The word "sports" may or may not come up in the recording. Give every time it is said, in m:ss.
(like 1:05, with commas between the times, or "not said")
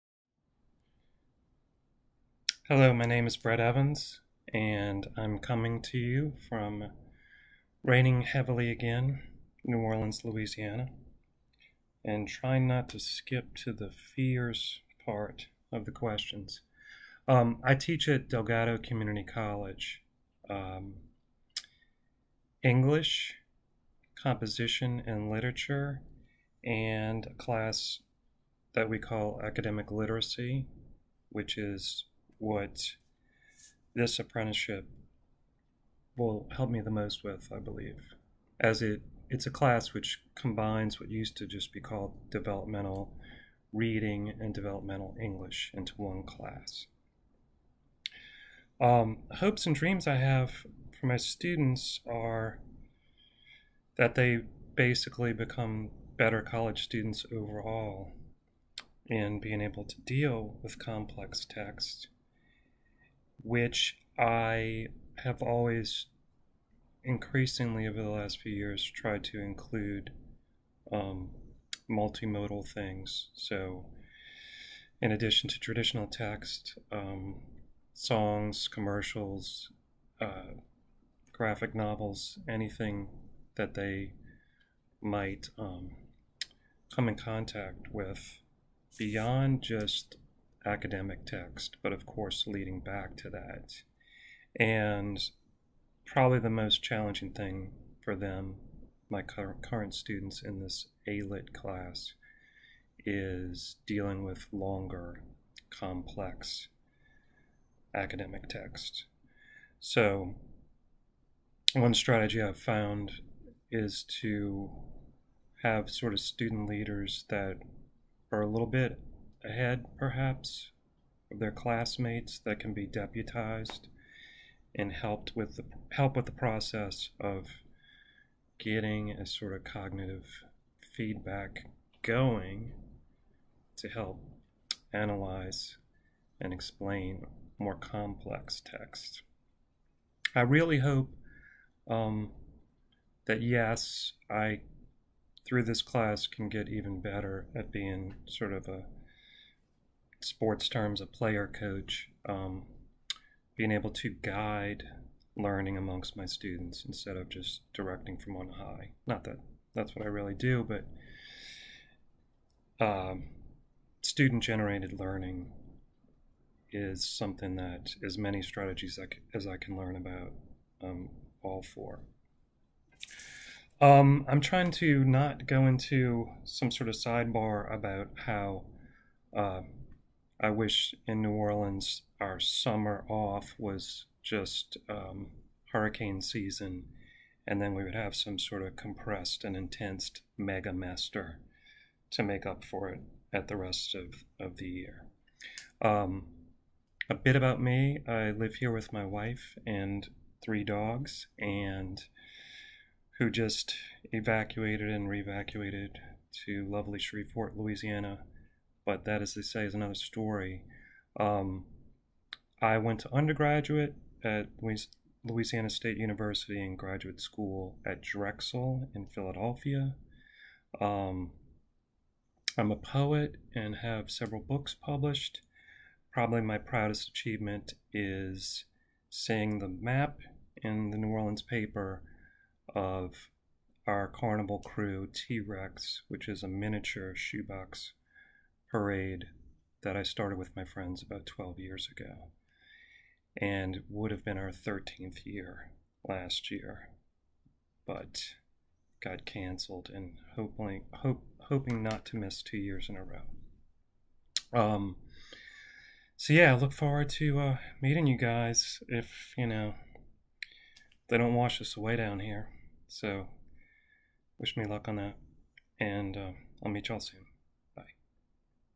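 2:30.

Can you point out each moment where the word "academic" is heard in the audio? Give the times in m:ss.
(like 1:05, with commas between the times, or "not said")
0:29, 1:30, 1:47.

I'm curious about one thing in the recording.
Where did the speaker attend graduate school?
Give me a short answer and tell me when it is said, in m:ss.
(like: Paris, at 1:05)
Drexel, at 3:38.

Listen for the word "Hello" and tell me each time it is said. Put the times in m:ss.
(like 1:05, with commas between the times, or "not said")
0:02.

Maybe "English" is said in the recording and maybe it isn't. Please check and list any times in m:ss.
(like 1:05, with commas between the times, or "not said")
0:22, 0:45.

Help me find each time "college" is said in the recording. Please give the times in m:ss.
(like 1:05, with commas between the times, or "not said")
0:19, 0:56.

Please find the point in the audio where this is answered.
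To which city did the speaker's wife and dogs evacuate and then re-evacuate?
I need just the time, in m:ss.
3:26.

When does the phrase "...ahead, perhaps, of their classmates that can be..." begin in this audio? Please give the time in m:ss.
1:59.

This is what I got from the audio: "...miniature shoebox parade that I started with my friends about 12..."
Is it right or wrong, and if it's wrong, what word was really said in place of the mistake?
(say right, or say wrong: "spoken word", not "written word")
right.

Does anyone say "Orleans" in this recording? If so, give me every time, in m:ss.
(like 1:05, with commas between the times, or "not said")
0:09, 3:01, 3:51.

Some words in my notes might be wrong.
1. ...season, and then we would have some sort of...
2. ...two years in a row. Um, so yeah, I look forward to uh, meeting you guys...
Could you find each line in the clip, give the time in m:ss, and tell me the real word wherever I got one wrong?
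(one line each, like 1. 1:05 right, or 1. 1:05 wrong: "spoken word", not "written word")
1. 3:06 right
2. 4:12 right.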